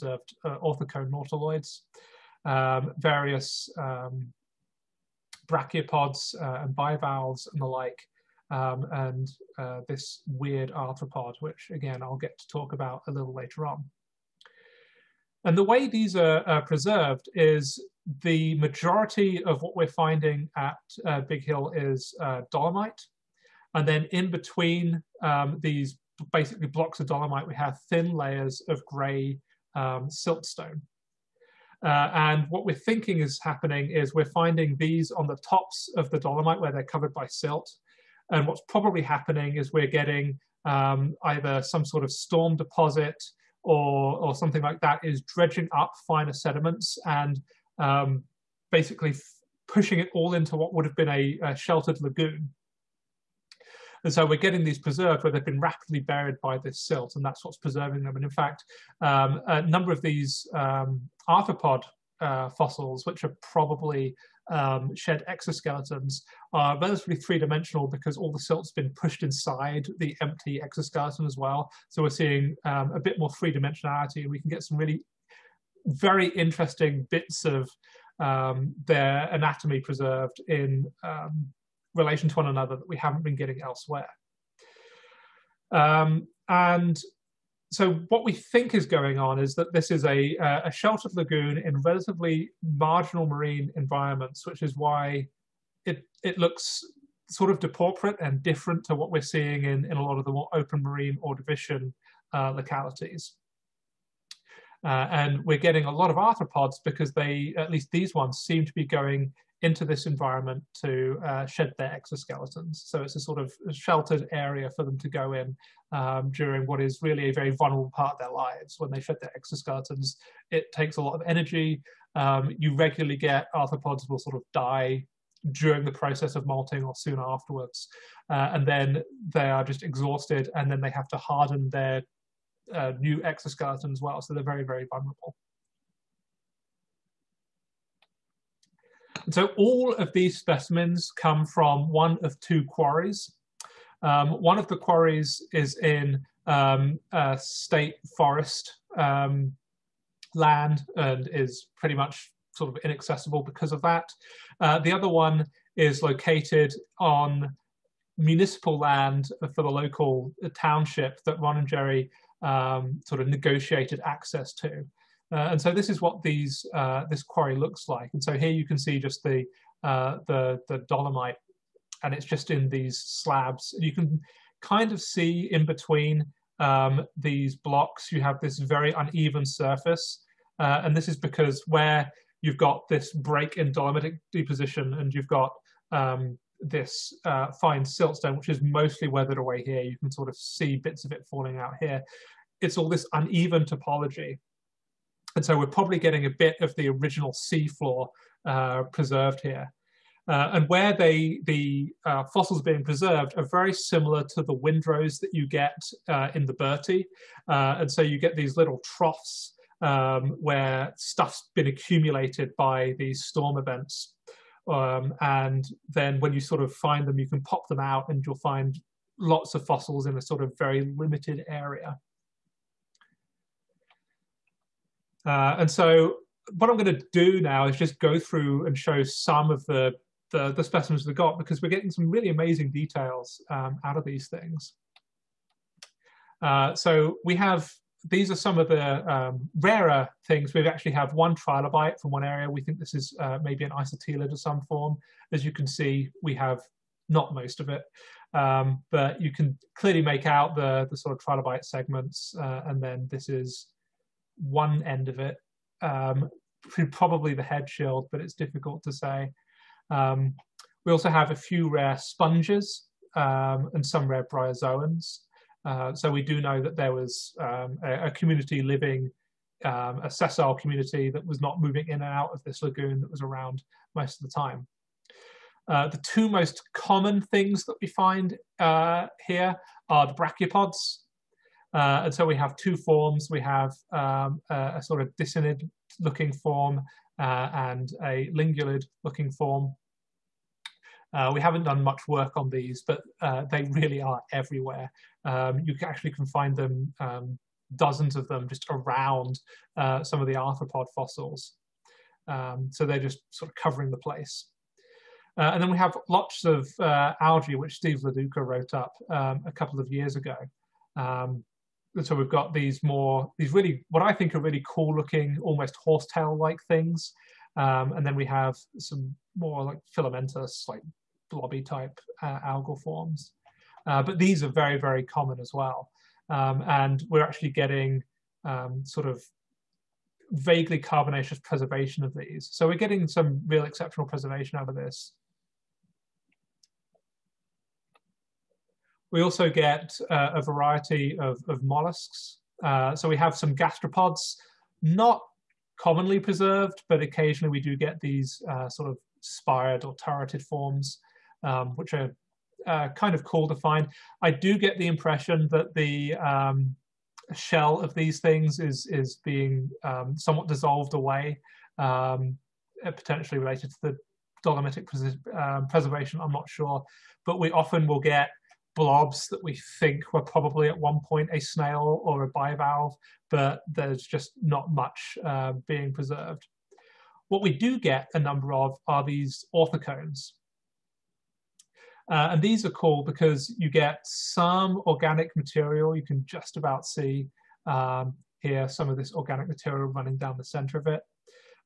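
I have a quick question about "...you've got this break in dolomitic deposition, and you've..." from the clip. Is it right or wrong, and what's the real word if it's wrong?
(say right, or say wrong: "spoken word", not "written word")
right.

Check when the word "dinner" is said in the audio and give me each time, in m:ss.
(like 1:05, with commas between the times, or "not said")
not said.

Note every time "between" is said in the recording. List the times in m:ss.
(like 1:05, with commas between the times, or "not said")
0:24, 2:55.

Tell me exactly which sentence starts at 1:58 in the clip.
When they shed their exoskeletons, it takes a lot of energy.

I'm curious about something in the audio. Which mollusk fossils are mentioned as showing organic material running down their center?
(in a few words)
orthocones.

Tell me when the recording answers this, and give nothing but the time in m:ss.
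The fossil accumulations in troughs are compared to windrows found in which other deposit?
3:26.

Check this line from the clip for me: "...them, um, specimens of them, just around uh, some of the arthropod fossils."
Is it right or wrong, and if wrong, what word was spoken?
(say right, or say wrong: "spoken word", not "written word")
wrong: "dozens", not "specimens".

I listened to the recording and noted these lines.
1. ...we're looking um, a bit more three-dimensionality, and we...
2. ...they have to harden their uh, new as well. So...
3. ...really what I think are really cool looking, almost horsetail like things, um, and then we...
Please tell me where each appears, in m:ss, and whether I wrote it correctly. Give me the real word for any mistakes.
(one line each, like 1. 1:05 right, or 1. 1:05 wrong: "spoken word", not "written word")
1. 1:12 wrong: "seeing", not "looking"
2. 2:10 right
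3. 5:13 right.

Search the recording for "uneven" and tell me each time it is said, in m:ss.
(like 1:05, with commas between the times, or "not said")
2:58, 3:13.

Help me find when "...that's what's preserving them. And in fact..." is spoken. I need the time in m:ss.
0:57.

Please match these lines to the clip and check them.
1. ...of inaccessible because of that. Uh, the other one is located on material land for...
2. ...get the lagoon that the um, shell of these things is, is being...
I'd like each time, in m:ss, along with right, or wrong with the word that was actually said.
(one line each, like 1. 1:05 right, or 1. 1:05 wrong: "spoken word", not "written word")
1. 2:32 wrong: "municipal", not "material"
2. 5:54 wrong: "impression", not "lagoon".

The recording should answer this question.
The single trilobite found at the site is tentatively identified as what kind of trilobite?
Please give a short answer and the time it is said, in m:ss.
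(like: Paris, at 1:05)
an isotelid, at 4:03.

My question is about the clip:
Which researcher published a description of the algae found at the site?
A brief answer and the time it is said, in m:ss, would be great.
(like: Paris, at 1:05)
Steve LoDuca, at 5:07.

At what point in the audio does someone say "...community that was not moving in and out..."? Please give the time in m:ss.
4:30.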